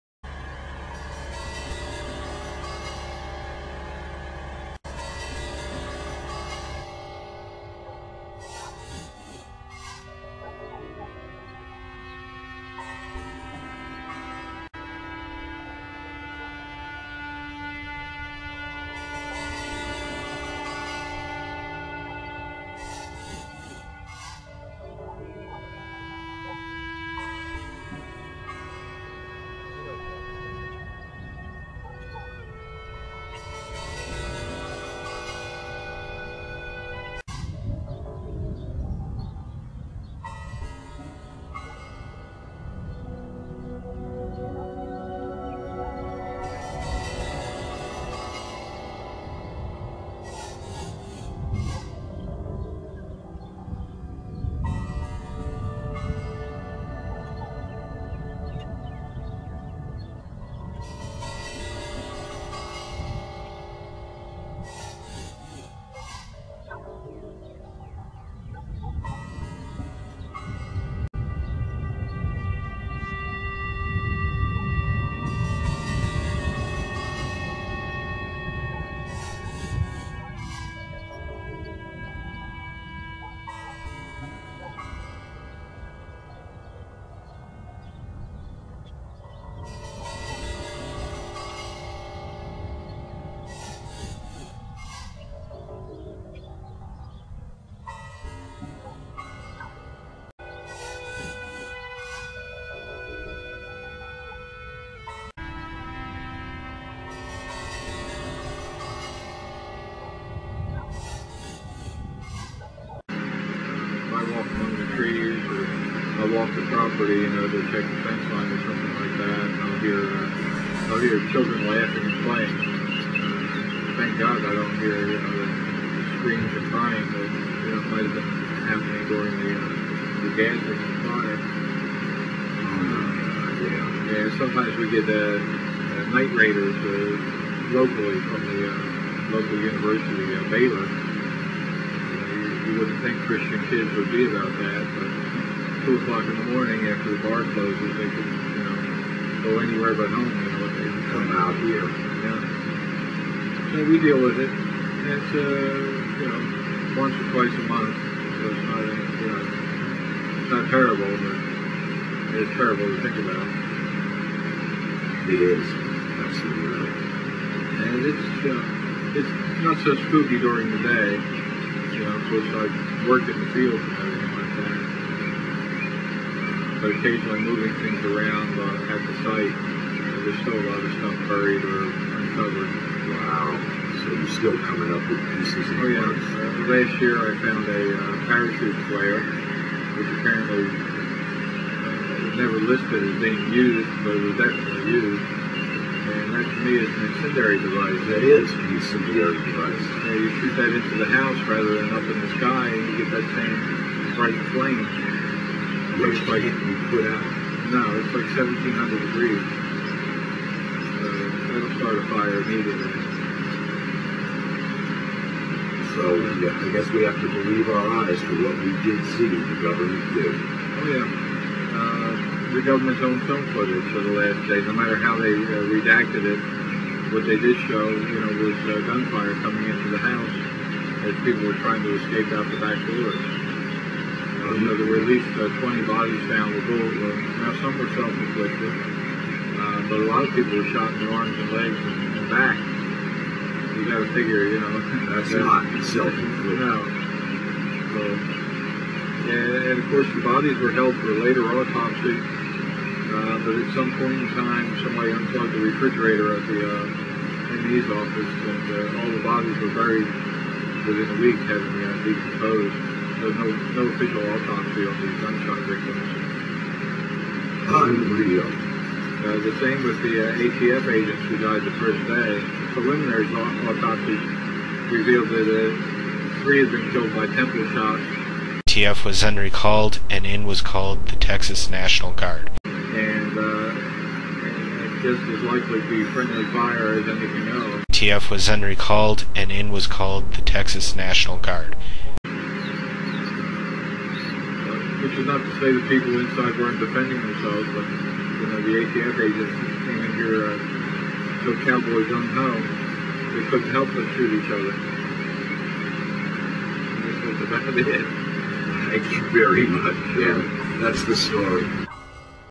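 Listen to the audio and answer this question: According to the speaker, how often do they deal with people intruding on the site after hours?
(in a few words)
Once or twice a month.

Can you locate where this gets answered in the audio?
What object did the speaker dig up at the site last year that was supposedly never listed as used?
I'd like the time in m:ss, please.
3:08.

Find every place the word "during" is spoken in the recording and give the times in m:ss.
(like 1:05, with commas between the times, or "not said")
2:09, 2:50.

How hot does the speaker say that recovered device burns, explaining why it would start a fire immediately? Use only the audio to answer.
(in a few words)
1700 degrees.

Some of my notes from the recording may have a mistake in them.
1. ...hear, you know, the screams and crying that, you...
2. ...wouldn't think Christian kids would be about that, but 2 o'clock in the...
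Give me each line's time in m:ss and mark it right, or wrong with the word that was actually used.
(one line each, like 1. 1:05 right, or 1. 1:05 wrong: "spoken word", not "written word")
1. 2:04 right
2. 2:22 right.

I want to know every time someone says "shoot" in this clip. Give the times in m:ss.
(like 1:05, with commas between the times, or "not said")
3:20, 5:04.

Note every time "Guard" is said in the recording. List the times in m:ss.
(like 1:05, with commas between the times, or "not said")
4:42, 4:51.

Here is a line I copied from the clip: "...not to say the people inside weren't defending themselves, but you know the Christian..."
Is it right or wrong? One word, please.
wrong.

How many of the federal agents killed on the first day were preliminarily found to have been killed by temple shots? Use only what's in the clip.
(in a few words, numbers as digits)
3.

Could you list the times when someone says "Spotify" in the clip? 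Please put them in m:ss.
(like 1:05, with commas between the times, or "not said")
not said.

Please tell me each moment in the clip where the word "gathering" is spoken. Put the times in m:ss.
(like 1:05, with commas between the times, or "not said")
2:10.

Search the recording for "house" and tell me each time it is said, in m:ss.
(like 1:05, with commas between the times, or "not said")
3:21, 3:49.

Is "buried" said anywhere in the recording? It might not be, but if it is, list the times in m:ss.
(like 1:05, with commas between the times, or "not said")
3:01, 4:19.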